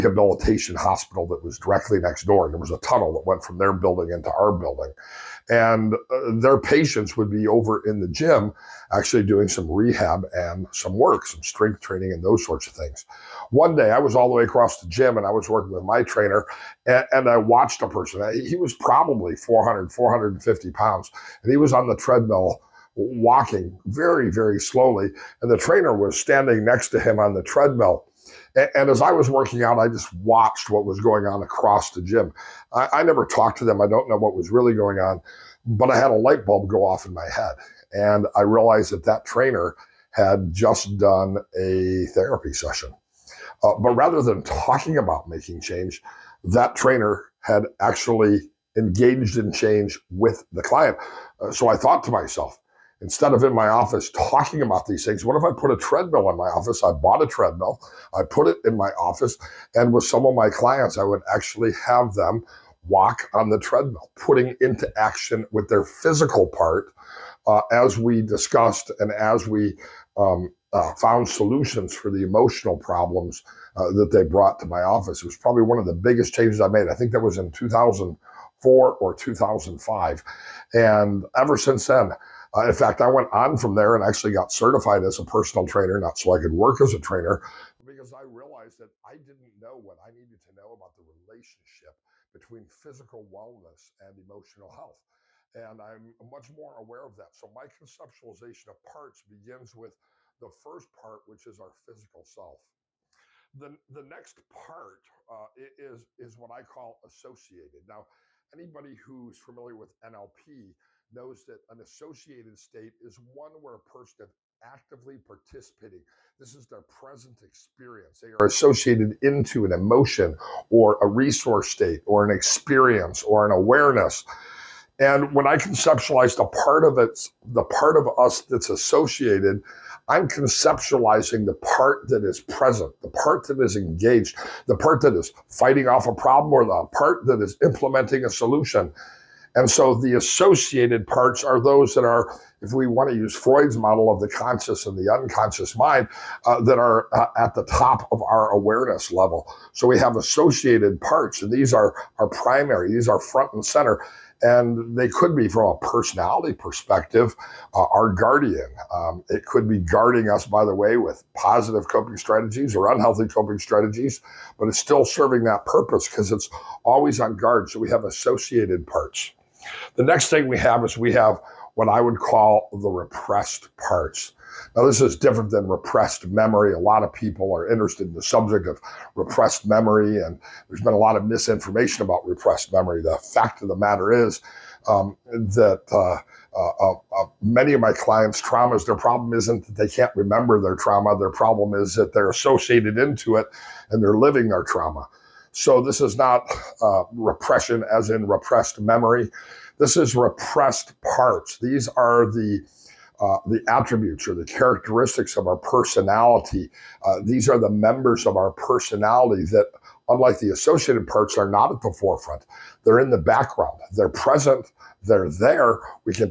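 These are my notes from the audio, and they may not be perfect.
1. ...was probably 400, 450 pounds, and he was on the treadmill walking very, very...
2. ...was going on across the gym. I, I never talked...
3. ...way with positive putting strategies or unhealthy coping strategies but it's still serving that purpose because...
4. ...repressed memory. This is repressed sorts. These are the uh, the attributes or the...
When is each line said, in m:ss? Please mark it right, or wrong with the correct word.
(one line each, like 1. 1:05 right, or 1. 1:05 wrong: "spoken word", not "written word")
1. 0:18 right
2. 0:30 right
3. 2:40 wrong: "coping", not "putting"
4. 3:18 wrong: "parts", not "sorts".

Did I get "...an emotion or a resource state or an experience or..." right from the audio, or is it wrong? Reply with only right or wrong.
right.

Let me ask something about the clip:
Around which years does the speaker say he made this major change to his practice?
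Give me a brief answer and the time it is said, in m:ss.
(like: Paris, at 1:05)
2004 or 2005, at 1:17.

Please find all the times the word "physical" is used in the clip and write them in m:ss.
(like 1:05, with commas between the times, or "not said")
1:05, 1:32, 1:41.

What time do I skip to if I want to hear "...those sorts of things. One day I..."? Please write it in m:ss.
0:12.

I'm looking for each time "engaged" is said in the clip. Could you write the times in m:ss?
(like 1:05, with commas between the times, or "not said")
0:48, 2:13.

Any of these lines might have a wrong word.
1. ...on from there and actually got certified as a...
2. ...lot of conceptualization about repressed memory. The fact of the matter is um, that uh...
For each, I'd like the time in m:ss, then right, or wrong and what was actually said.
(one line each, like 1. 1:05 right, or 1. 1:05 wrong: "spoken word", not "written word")
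1. 1:23 right
2. 3:00 wrong: "misinformation", not "conceptualization".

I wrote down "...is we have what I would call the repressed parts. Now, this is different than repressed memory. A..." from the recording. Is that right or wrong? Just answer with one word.
right.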